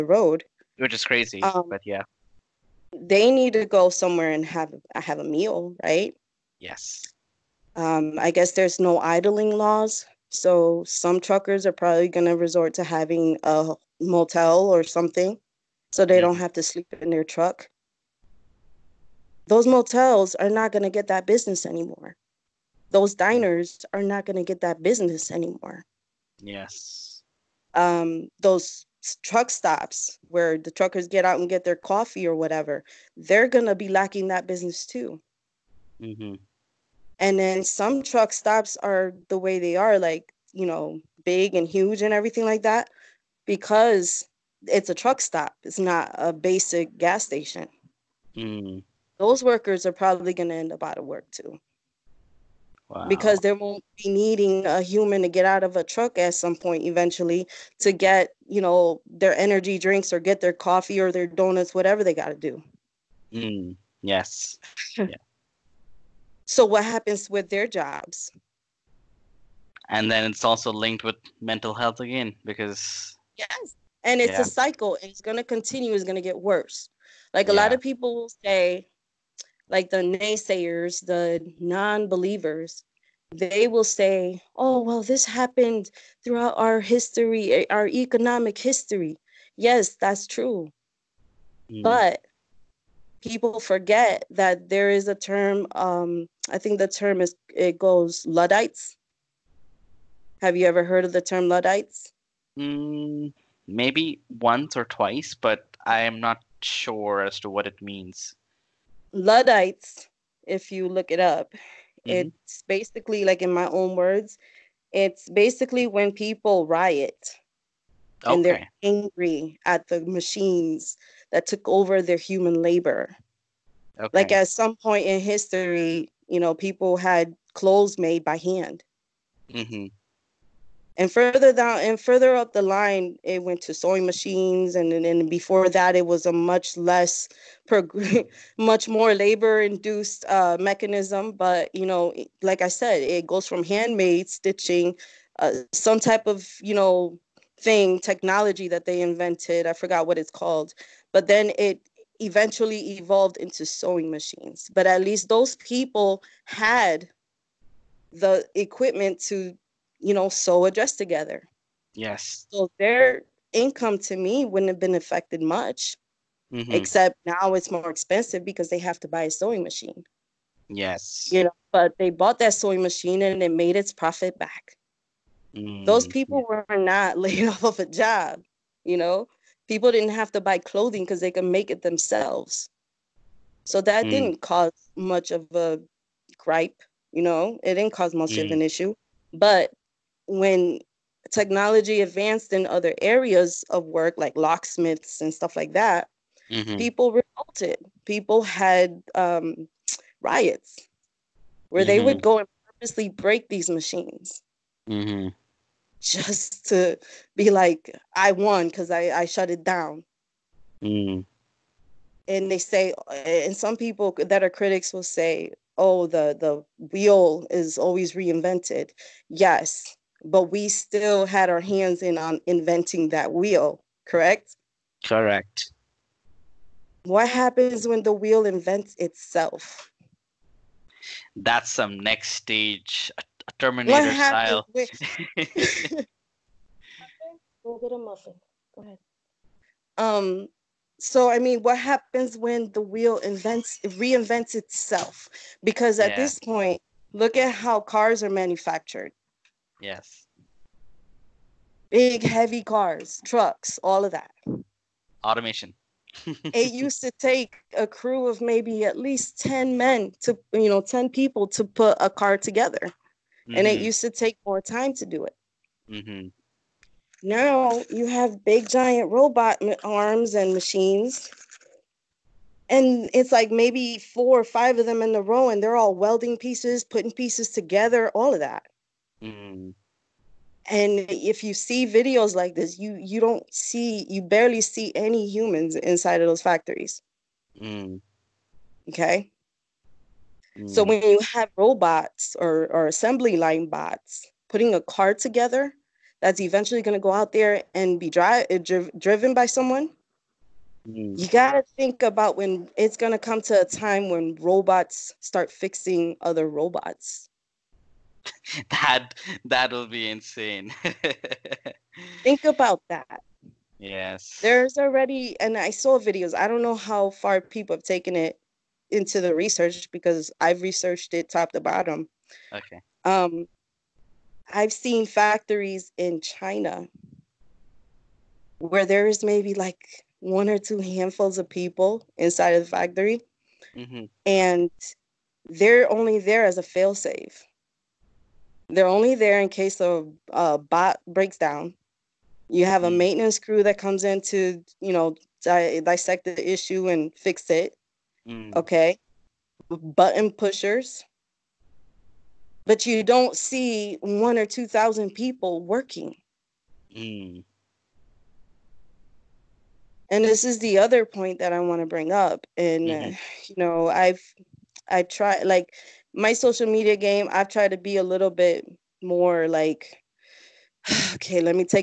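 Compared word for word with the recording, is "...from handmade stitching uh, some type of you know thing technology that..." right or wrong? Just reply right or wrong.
right.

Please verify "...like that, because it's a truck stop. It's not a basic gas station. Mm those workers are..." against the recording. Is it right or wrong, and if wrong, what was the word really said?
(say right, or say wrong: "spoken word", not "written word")
right.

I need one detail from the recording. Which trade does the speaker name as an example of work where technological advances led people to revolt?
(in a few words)
locksmiths.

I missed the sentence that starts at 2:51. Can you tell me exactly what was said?
You know, but they bought that sewing machine and it made its profit back.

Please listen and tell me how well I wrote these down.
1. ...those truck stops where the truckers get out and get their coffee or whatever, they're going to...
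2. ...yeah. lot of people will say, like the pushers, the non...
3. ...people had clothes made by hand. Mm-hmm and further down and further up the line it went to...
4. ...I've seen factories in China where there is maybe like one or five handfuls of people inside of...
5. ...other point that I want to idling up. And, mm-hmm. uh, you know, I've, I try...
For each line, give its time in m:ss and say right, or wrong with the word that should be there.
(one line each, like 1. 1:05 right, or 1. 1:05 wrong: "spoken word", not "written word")
1. 0:28 right
2. 1:17 wrong: "naysayers", not "pushers"
3. 2:06 right
4. 5:24 wrong: "two", not "five"
5. 6:00 wrong: "bring", not "idling".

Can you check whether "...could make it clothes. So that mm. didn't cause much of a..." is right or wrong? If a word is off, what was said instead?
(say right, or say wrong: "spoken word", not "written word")
wrong: "themselves", not "clothes".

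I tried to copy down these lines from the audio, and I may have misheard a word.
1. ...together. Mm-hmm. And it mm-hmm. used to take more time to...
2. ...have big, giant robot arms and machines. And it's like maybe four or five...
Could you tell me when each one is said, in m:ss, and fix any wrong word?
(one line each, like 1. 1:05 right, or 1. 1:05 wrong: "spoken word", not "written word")
1. 4:22 right
2. 4:28 right.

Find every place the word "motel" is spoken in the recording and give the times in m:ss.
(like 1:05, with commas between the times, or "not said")
0:14, 0:19.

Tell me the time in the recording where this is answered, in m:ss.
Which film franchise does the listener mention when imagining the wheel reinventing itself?
3:53.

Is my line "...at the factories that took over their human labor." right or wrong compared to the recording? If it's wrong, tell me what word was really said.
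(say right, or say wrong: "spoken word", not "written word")
wrong: "machines", not "factories".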